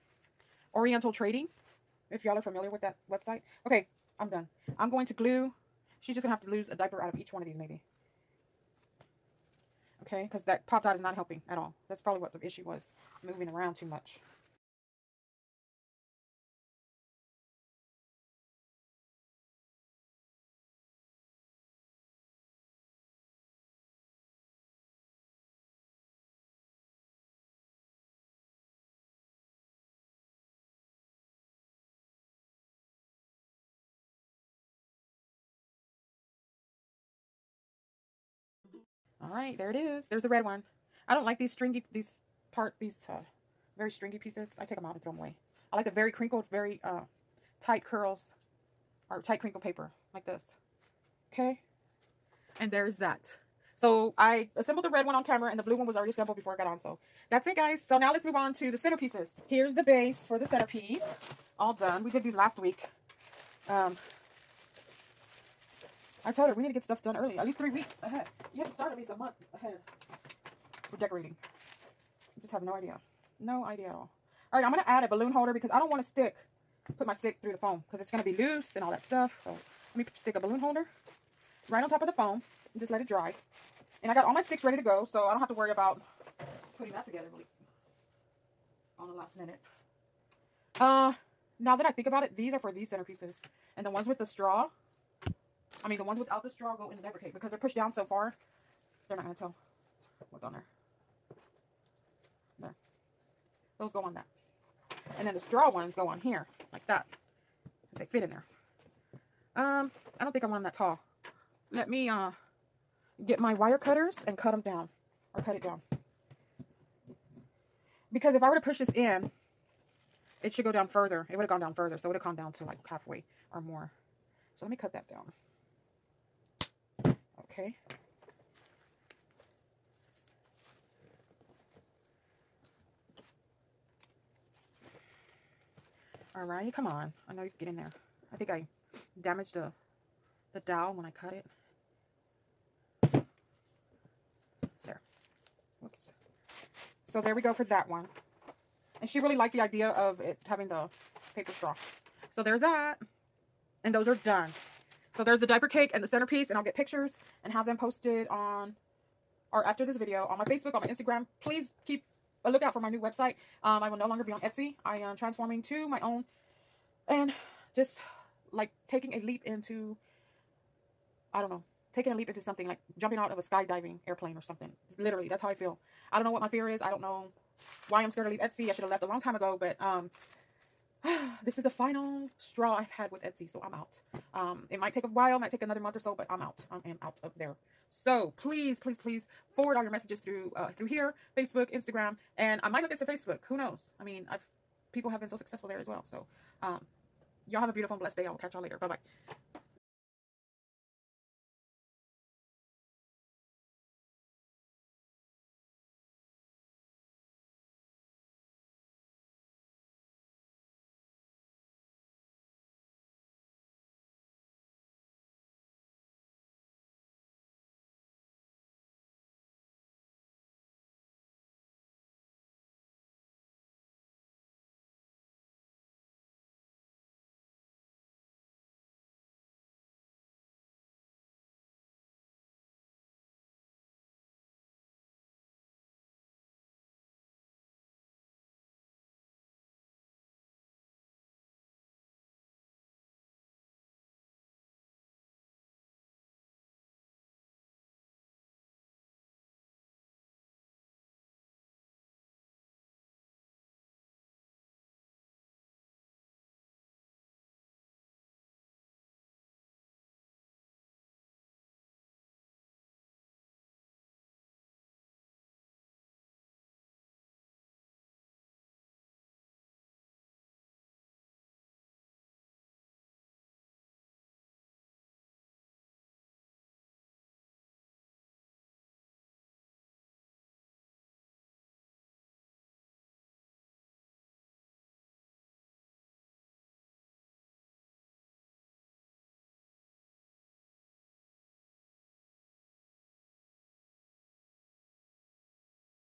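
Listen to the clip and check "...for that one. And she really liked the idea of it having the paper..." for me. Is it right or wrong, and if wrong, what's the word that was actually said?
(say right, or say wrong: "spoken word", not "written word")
right.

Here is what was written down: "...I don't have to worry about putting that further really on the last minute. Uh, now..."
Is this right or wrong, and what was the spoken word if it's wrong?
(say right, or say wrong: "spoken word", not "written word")
wrong: "together", not "further".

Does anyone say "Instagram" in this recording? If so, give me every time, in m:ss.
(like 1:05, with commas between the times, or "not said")
2:40, 3:11.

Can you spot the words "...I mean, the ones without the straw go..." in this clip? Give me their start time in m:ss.
1:35.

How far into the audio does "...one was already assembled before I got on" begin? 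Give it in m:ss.
0:55.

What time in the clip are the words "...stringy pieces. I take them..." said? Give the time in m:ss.
0:43.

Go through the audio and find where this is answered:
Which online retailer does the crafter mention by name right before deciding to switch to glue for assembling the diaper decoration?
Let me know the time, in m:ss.
0:00.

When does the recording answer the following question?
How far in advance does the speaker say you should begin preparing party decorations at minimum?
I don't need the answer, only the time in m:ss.
1:09.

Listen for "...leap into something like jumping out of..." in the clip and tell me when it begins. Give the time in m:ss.
2:52.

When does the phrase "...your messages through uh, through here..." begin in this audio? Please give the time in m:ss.
3:09.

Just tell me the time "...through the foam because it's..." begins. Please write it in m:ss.
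1:17.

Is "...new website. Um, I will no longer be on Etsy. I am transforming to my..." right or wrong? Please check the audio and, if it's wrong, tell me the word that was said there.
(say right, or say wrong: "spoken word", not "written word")
right.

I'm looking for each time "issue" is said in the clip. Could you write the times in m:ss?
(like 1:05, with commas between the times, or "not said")
0:12.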